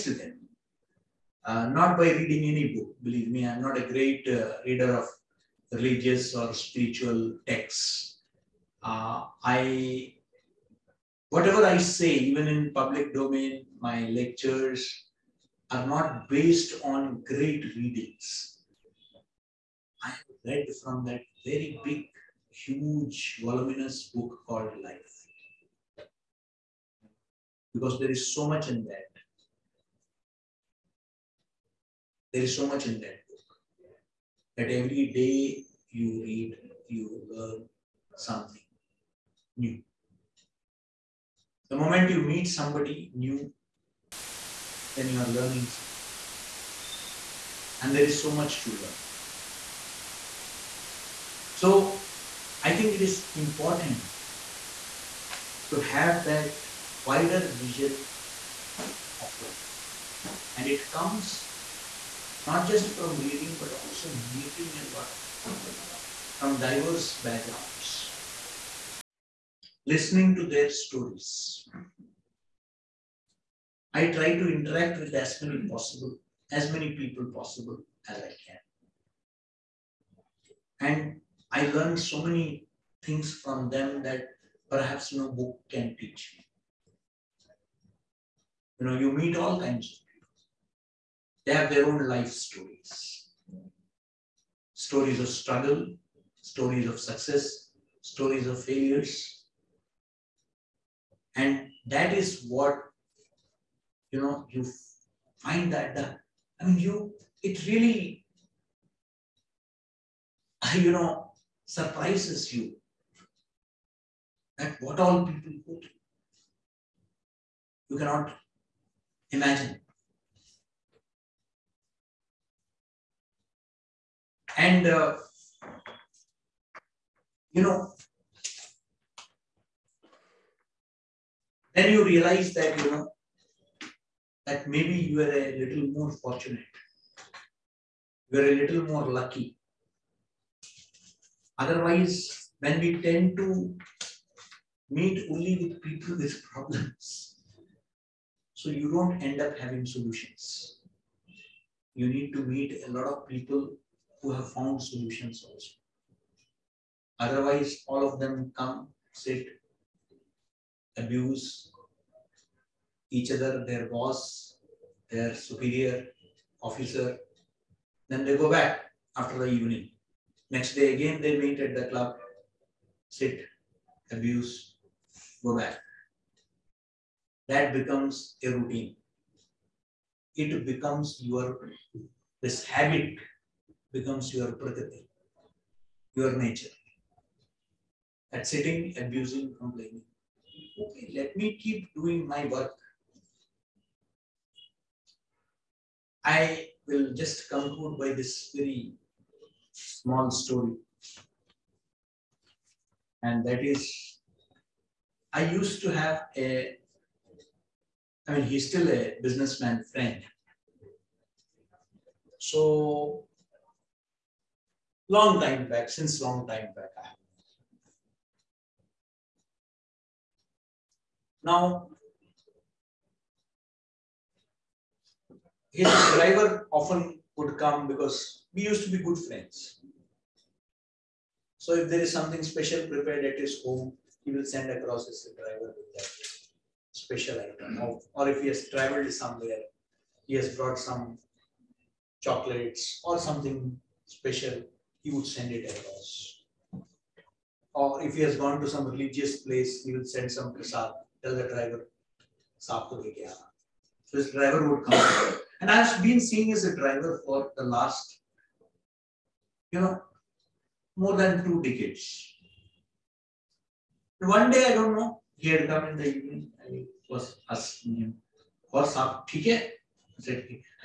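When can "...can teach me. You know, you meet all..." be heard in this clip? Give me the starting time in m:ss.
1:25.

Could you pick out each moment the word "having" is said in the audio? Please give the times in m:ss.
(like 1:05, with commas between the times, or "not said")
2:29.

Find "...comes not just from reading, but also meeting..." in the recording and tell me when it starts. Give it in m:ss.
1:00.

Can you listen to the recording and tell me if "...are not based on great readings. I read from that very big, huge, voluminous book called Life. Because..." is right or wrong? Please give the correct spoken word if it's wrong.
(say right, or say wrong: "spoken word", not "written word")
right.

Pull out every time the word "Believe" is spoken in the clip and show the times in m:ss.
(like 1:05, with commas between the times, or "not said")
0:03.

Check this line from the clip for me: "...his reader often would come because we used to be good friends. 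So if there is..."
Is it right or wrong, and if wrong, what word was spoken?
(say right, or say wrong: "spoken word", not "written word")
wrong: "driver", not "reader".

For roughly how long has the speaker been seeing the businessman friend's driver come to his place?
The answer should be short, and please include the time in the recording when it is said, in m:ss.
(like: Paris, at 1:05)
more than 2 decades, at 4:20.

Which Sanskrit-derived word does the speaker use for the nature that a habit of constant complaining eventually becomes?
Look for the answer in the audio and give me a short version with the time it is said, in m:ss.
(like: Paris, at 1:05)
prakriti, at 3:04.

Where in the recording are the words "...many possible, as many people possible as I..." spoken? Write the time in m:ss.
1:15.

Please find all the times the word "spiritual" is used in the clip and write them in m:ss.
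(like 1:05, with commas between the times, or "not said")
0:06.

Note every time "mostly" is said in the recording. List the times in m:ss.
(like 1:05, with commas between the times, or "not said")
not said.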